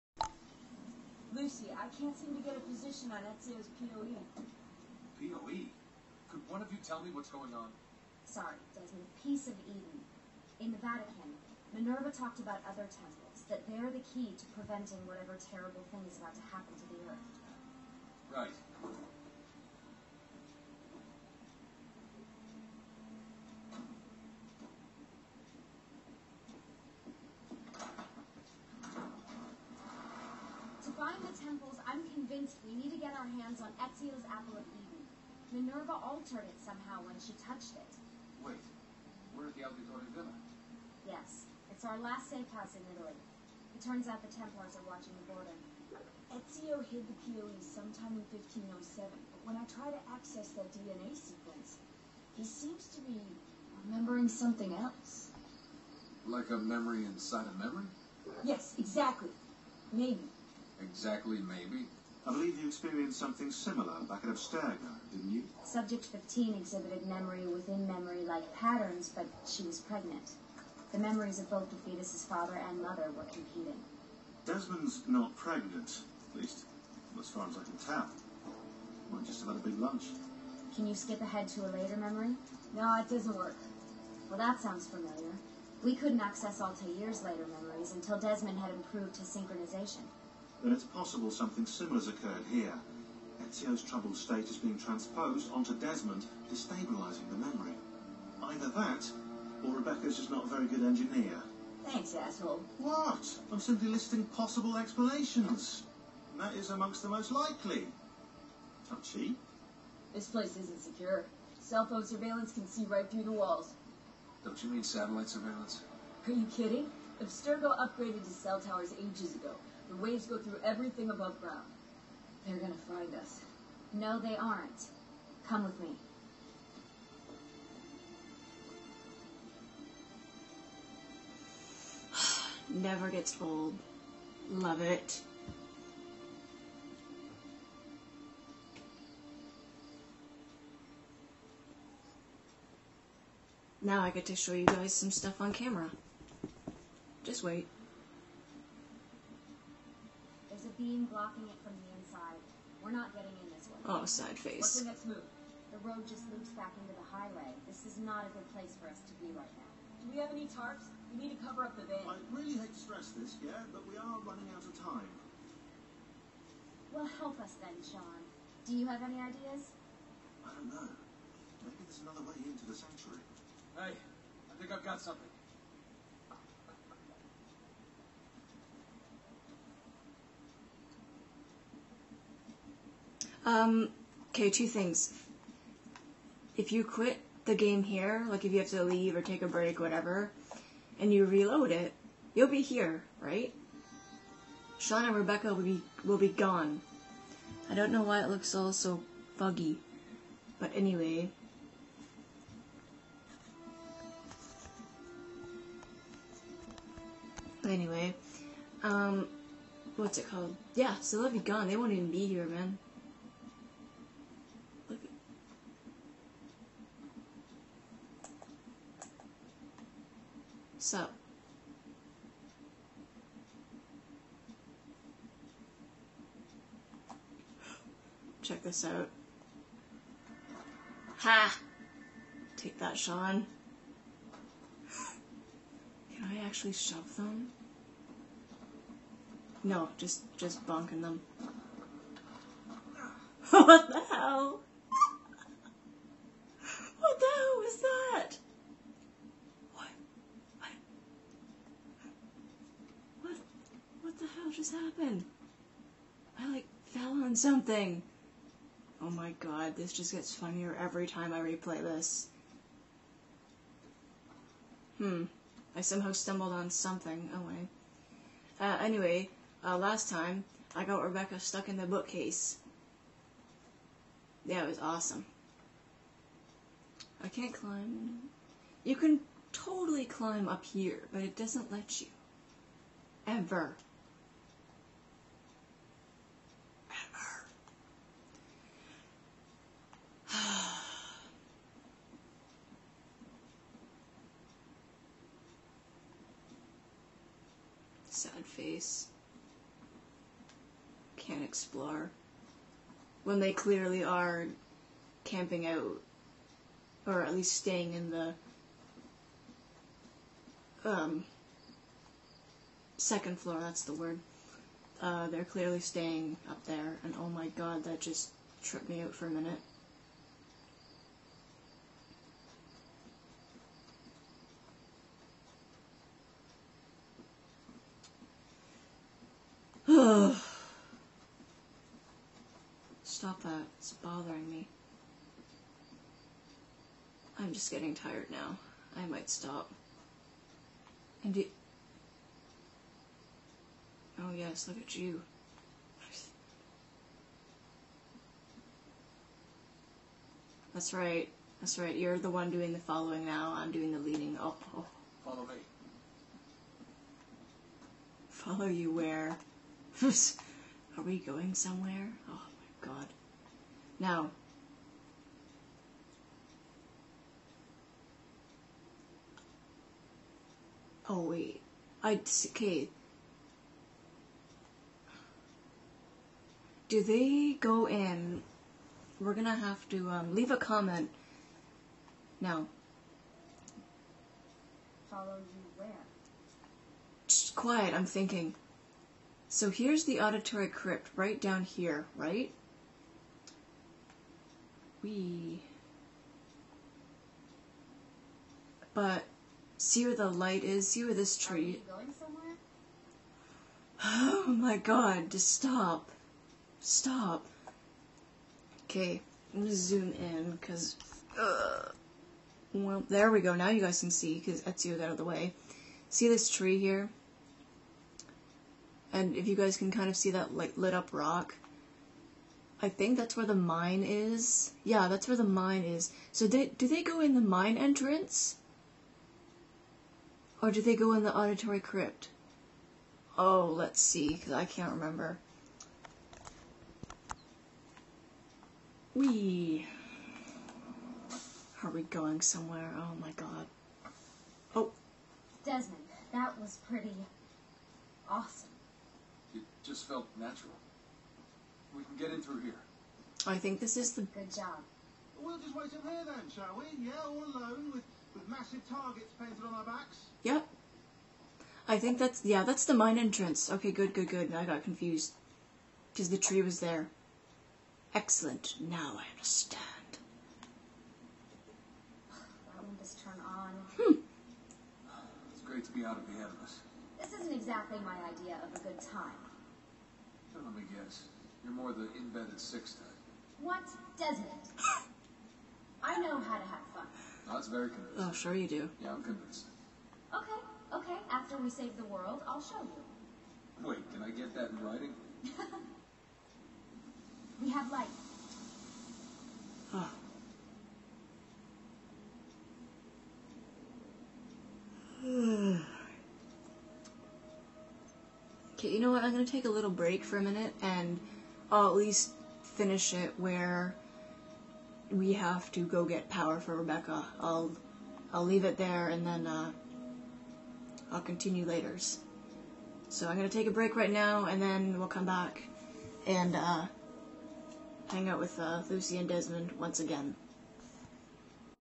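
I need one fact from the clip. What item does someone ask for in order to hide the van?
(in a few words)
Tarps.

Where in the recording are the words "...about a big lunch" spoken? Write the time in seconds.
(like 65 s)
79 s.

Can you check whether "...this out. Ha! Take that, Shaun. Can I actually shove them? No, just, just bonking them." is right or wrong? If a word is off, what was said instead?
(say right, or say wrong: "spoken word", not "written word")
right.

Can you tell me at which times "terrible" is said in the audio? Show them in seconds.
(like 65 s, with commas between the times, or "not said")
15 s.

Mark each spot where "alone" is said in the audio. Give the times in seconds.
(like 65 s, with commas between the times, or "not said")
457 s.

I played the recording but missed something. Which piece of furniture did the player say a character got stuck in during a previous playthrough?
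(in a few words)
Bookcase.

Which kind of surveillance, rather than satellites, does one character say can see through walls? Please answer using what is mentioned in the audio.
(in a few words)
Cell phone surveillance.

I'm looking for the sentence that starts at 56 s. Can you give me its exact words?
Like a memory inside a memory?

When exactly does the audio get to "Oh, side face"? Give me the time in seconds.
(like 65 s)
153 s.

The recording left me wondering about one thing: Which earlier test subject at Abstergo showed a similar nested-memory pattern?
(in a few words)
Subject 15.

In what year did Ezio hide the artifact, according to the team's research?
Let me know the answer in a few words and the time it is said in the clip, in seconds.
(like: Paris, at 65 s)
1507, at 48 s.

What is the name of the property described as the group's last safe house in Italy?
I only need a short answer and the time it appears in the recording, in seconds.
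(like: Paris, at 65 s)
Auditore Villa, at 39 s.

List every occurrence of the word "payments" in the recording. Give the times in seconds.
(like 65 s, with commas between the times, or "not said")
not said.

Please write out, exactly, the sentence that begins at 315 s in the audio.
Uh, they're clearly staying up there, and oh my god, that just tripped me out for a minute.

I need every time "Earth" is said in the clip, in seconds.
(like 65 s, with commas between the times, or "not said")
17 s.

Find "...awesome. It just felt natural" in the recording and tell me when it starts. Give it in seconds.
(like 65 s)
448 s.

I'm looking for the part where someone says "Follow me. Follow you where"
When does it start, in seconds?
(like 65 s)
355 s.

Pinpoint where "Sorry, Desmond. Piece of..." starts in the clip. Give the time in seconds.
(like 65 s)
8 s.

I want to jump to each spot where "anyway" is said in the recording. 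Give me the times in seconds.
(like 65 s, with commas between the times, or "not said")
200 s, 207 s, 268 s.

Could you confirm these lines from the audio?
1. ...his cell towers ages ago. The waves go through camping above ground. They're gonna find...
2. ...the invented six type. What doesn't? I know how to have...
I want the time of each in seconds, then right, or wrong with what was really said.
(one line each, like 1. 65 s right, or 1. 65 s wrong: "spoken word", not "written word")
1. 118 s wrong: "everything", not "camping"
2. 481 s right.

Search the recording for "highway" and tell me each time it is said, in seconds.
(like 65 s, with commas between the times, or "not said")
157 s.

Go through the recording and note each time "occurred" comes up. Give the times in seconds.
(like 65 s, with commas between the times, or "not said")
92 s.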